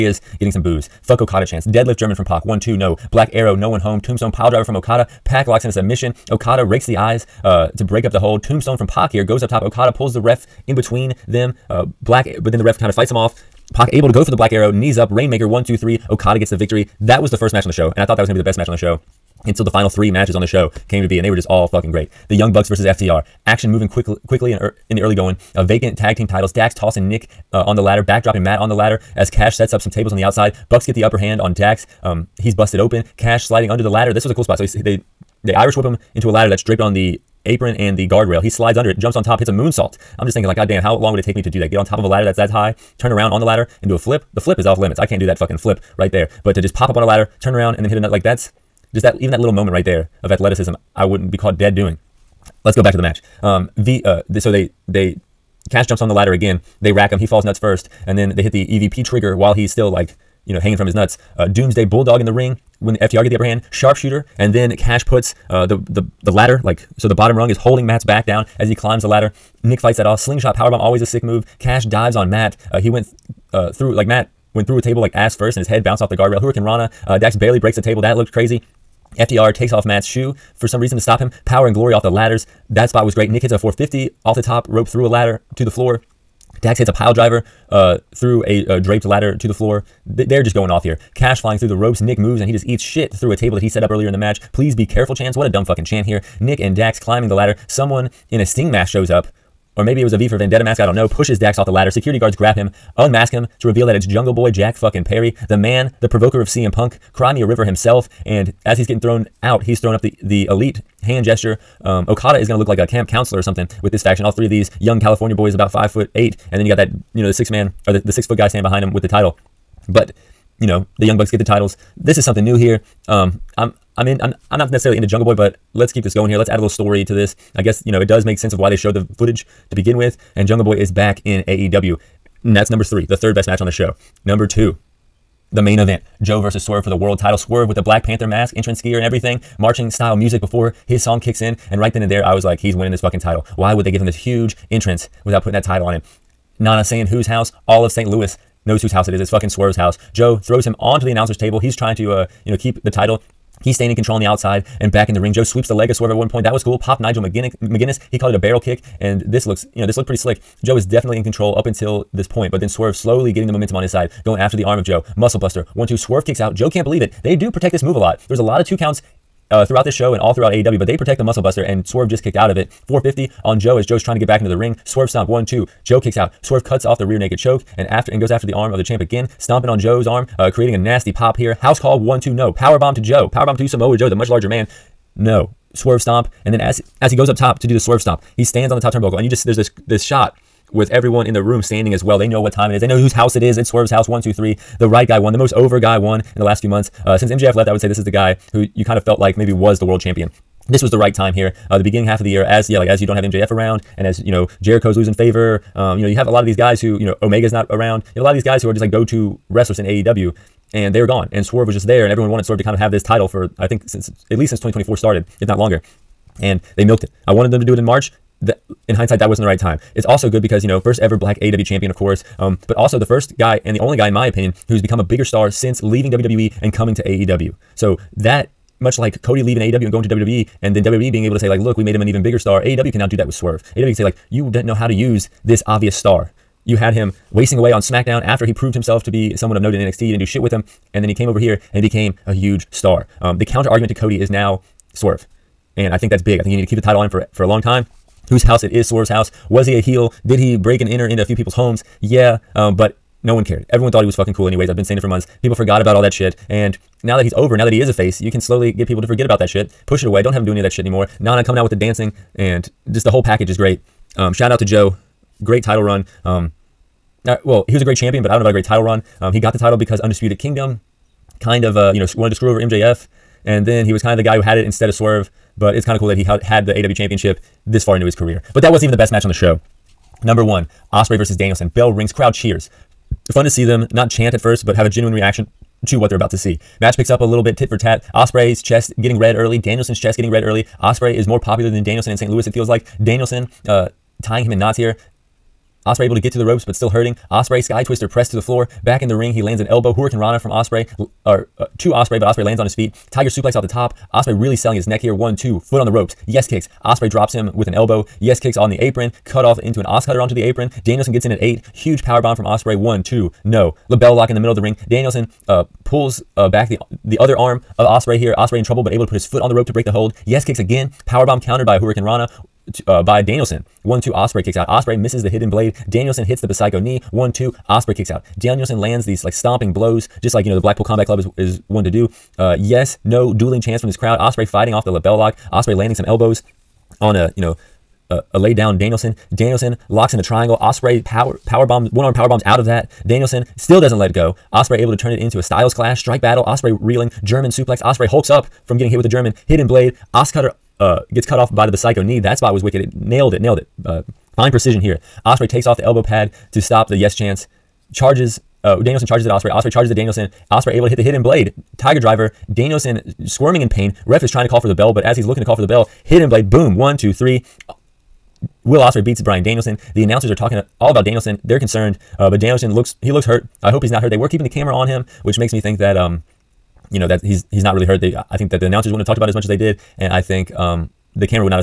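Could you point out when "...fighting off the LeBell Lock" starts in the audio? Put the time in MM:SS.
05:34.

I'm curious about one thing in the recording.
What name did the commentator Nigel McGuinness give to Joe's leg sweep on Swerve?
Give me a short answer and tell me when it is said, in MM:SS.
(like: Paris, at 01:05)
Barrel kick, at 02:38.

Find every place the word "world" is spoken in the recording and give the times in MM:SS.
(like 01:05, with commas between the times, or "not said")
02:16, 03:19.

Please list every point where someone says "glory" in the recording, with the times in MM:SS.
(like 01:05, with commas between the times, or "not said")
01:21.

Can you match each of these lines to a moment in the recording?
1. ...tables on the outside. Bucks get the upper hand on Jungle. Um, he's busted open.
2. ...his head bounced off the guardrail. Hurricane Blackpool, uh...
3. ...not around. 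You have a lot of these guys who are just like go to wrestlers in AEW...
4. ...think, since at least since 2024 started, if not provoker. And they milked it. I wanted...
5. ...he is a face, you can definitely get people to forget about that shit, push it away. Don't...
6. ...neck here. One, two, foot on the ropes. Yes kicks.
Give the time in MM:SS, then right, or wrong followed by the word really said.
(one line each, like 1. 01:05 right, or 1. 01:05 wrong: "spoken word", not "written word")
1. 00:29 wrong: "Dax", not "Jungle"
2. 01:15 wrong: "Rana", not "Blackpool"
3. 03:27 right
4. 03:33 wrong: "longer", not "provoker"
5. 04:17 wrong: "slowly", not "definitely"
6. 05:04 right.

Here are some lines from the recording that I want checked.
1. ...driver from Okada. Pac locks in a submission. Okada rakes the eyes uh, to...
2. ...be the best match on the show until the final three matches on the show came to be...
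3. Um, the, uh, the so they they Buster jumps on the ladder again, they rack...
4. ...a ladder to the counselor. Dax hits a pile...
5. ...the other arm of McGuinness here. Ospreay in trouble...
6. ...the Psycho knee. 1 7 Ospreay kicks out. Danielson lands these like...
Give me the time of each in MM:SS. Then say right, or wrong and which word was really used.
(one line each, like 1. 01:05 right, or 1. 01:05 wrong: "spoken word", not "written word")
1. 00:04 right
2. 00:18 right
3. 00:53 wrong: "Cash", not "Buster"
4. 01:25 wrong: "floor", not "counselor"
5. 05:17 wrong: "Ospreay", not "McGuinness"
6. 05:26 wrong: "2", not "7".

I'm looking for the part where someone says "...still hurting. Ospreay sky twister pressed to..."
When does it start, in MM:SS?
04:56.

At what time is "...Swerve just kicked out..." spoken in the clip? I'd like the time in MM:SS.
02:51.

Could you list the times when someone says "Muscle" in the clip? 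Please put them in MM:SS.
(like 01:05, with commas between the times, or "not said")
02:45, 02:51.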